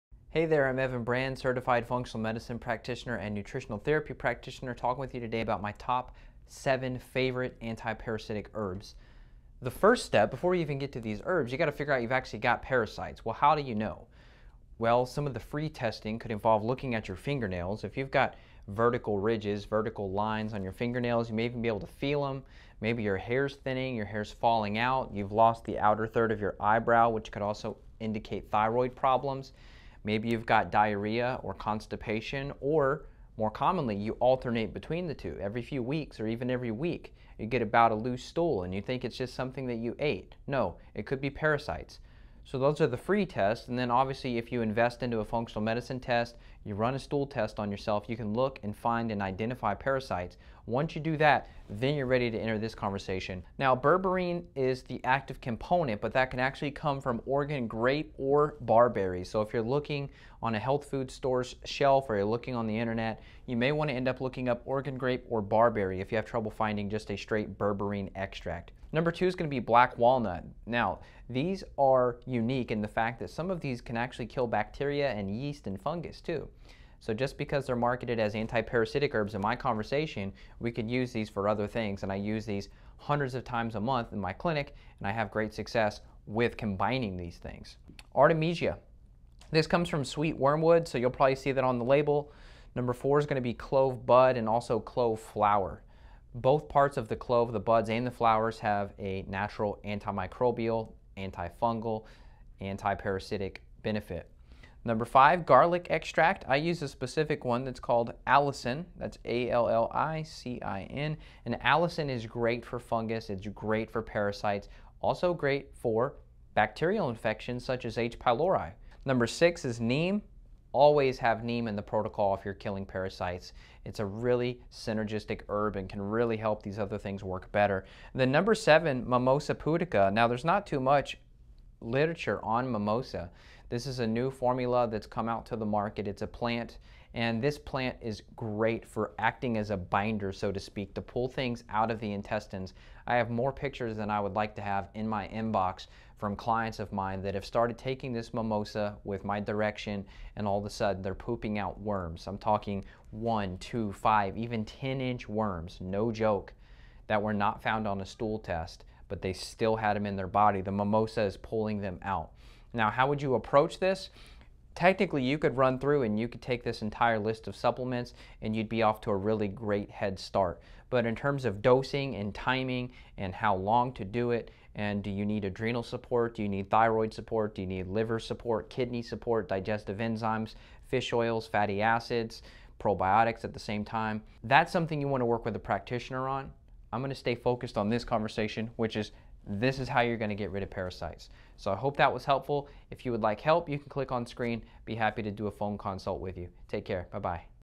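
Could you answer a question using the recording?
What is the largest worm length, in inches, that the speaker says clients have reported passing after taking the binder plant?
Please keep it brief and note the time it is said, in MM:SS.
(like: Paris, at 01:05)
10 inches, at 02:34.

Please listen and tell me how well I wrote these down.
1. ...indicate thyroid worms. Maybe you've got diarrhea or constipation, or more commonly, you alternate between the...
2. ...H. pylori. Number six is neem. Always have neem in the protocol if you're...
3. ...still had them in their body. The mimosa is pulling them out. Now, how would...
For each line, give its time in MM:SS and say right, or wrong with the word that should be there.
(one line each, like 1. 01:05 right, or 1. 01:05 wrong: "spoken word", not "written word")
1. 00:27 wrong: "problems", not "worms"
2. 01:57 right
3. 02:39 right.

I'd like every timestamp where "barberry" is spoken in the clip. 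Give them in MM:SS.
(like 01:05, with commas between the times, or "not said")
00:58, 01:05.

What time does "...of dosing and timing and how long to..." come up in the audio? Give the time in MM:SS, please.
02:51.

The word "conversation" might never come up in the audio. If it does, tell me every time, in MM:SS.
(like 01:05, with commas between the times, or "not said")
00:52, 01:19, 03:08.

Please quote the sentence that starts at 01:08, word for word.
Number two is going to be black walnut.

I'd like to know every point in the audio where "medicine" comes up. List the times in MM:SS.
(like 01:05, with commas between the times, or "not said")
00:02, 00:45.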